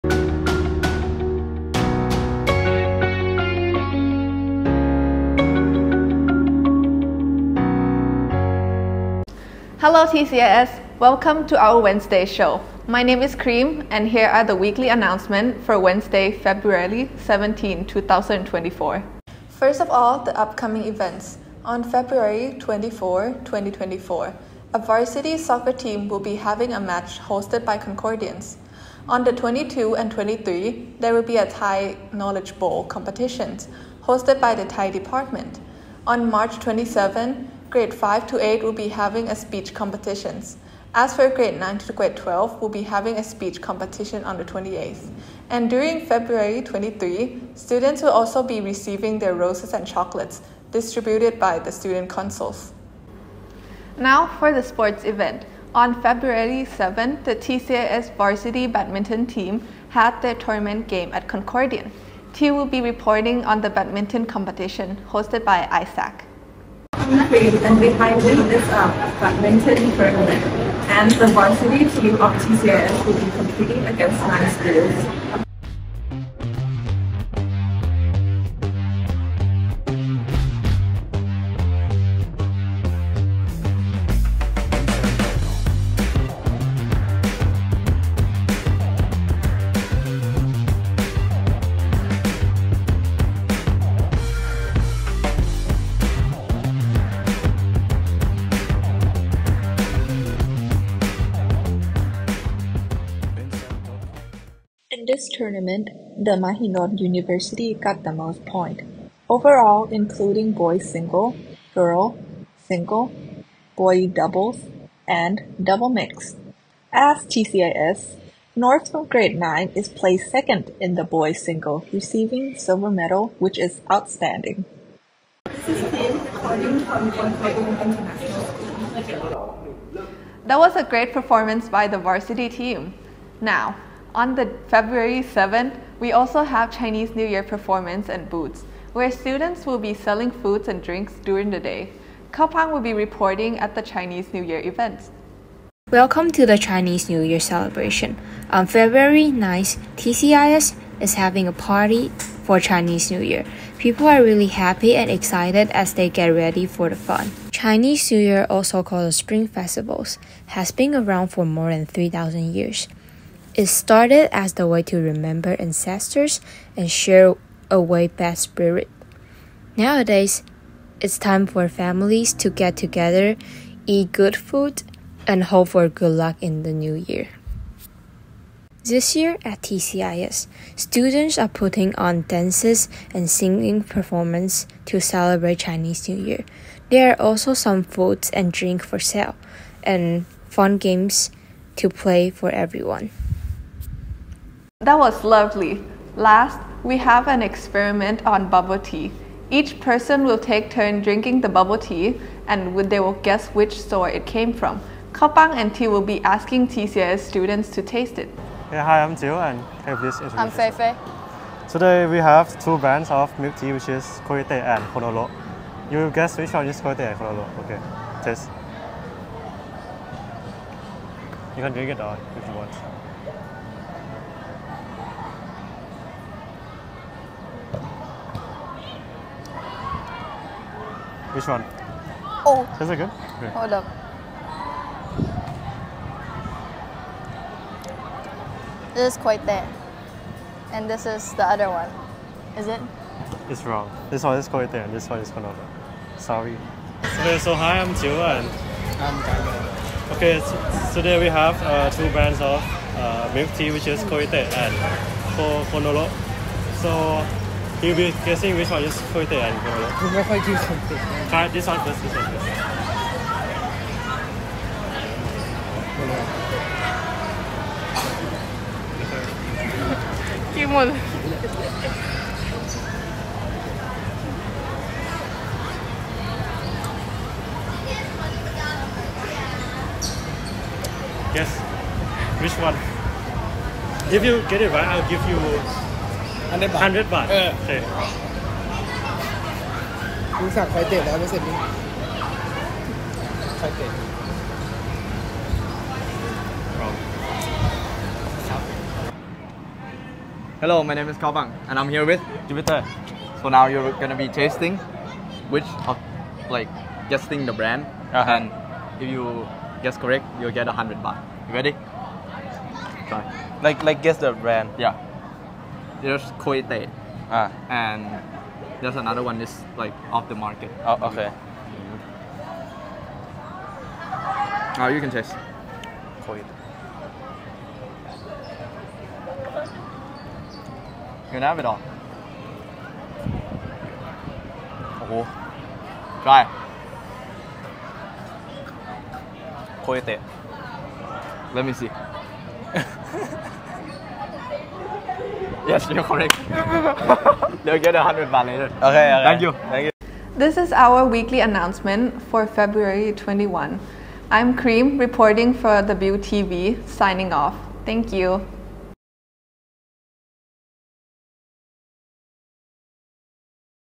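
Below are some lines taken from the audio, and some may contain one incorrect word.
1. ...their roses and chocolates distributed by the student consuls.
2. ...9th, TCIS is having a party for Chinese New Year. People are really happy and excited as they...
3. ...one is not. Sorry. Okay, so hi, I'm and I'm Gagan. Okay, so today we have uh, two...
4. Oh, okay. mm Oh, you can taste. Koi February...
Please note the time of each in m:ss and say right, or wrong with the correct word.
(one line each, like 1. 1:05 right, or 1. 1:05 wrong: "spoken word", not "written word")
1. 0:49 right
2. 2:29 right
3. 4:05 right
4. 5:20 wrong: "You", not "February".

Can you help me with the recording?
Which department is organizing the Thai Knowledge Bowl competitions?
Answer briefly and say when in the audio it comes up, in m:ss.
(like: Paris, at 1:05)
Thai department, at 0:34.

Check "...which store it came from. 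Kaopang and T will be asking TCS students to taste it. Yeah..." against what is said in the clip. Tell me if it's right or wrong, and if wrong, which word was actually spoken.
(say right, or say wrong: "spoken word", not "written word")
right.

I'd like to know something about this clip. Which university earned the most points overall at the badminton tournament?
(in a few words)
Mahidol University.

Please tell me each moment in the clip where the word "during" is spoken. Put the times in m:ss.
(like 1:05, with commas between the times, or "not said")
0:45, 2:21.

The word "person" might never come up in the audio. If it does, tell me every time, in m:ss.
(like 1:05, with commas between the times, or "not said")
3:19.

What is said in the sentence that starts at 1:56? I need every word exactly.
As TCIS, North from grade 9 is placed second in the boys single, receiving silver medal, which is outstanding.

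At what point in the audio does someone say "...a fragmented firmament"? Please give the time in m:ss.
1:08.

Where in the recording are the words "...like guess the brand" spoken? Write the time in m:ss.
5:13.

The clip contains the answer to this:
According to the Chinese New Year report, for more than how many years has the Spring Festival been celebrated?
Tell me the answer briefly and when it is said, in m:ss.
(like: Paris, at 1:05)
3,000, at 2:41.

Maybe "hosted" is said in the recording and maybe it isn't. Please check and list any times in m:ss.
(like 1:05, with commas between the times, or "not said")
0:27, 0:34, 1:05.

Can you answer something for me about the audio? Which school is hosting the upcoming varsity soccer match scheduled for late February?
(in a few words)
Concordians.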